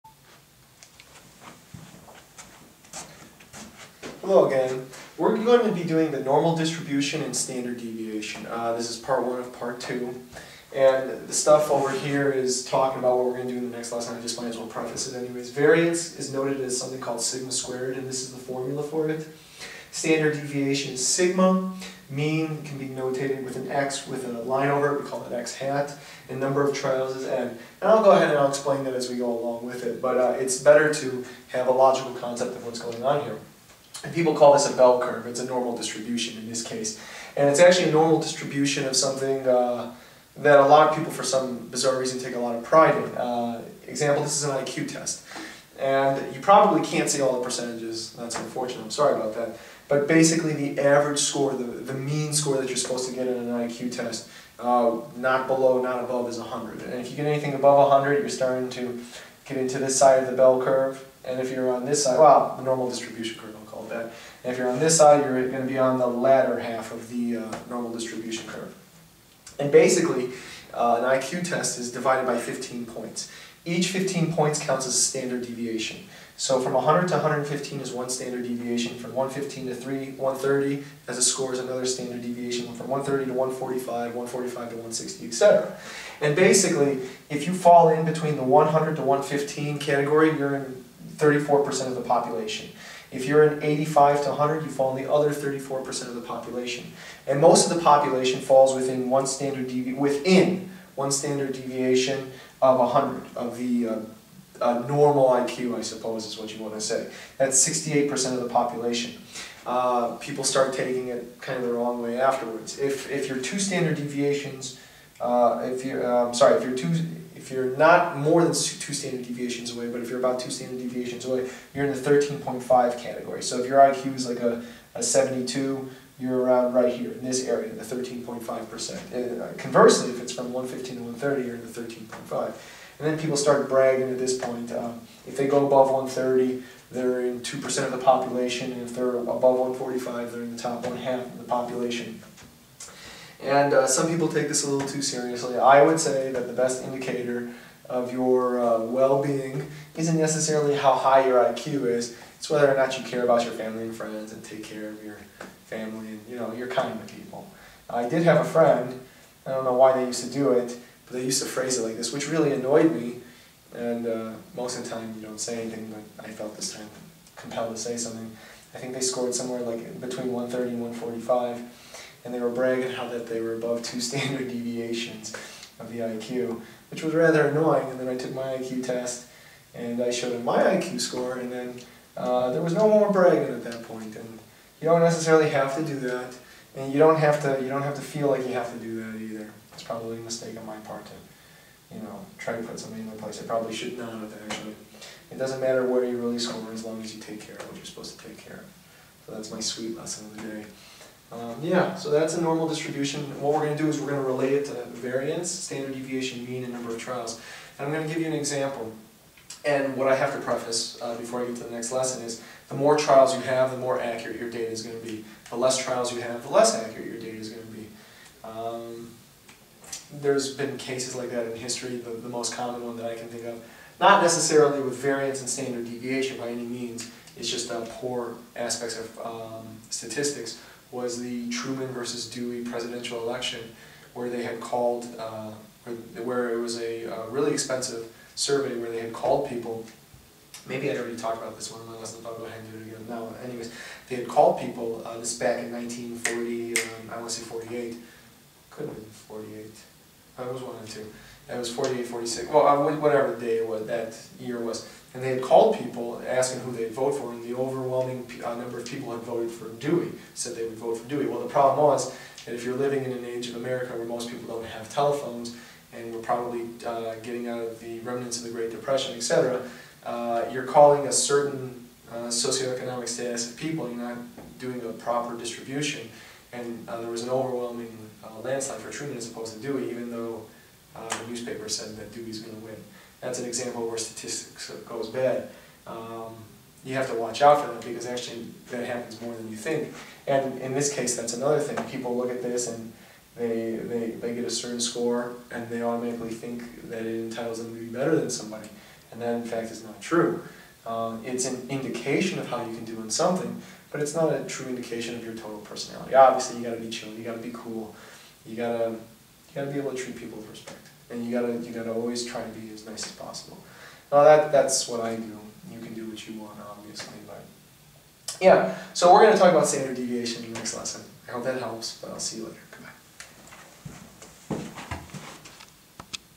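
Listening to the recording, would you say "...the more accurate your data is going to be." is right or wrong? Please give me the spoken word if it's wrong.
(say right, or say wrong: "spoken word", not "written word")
right.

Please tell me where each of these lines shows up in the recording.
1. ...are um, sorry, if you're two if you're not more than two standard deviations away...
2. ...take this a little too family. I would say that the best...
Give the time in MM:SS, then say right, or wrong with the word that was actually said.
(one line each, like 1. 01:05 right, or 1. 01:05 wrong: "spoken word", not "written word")
1. 01:56 right
2. 02:24 wrong: "seriously", not "family".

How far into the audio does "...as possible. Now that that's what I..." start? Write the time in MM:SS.
05:13.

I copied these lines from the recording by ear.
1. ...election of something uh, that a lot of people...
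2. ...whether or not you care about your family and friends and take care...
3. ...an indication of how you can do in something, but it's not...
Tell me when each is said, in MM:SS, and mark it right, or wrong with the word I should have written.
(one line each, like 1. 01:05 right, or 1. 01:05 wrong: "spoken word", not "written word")
1. 00:38 wrong: "distribution", not "election"
2. 02:32 right
3. 05:01 right.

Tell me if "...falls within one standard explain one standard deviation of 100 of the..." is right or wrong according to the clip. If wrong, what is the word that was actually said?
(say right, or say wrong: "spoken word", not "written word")
wrong: "within", not "explain".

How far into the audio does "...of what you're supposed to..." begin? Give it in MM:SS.
03:17.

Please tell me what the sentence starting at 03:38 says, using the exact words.
Um, there's been cases like that in history, the, the most common one that I can think of.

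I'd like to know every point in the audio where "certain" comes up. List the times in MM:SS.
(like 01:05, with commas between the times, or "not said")
04:31, 04:54.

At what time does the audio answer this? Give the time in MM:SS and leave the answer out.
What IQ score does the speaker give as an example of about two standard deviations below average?
02:05.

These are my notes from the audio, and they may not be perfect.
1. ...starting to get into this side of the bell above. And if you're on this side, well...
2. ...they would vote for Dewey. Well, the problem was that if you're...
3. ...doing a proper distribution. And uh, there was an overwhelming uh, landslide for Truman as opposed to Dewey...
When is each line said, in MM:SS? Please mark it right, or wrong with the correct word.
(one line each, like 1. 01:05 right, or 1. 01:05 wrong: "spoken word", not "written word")
1. 00:58 wrong: "curve", not "above"
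2. 04:20 right
3. 04:34 right.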